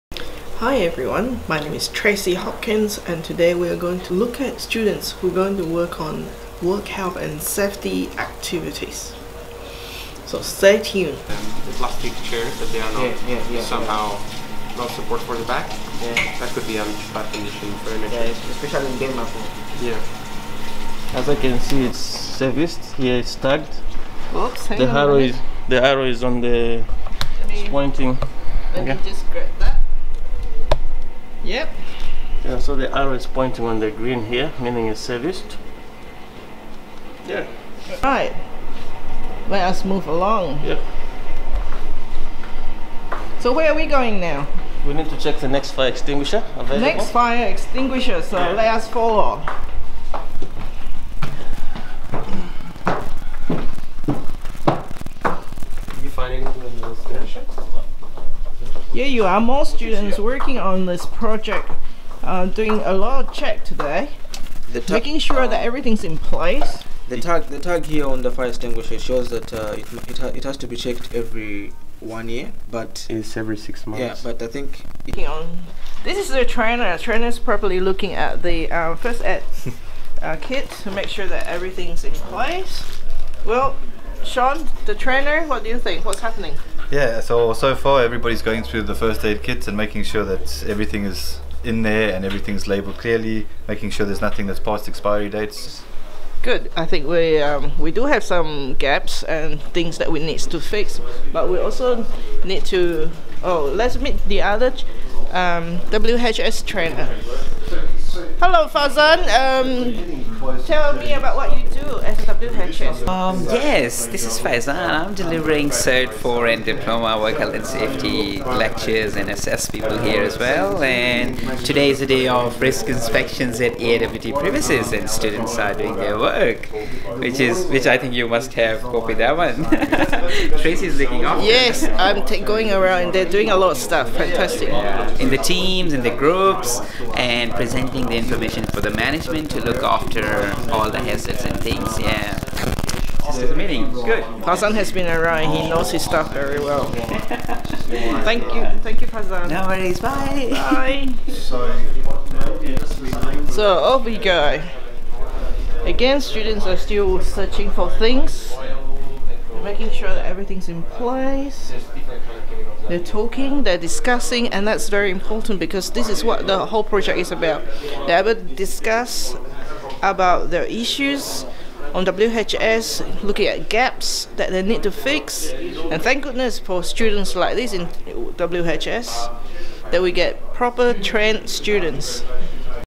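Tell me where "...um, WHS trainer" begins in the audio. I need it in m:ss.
1:45.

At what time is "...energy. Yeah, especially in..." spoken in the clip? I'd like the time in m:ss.
0:17.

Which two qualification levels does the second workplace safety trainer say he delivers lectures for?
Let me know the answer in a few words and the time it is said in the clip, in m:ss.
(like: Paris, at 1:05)
Cert 4 and Diploma, at 1:55.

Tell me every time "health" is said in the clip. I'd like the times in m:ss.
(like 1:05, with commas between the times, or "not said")
0:06, 1:57.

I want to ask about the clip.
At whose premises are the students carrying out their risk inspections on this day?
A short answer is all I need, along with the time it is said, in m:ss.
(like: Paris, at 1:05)
AIWT, at 2:03.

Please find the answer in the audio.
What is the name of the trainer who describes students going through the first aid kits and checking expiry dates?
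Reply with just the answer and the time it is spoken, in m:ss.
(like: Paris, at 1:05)
Sean, at 1:24.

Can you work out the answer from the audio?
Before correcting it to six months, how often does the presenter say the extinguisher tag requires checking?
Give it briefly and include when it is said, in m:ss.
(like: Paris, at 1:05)
every one year, at 1:11.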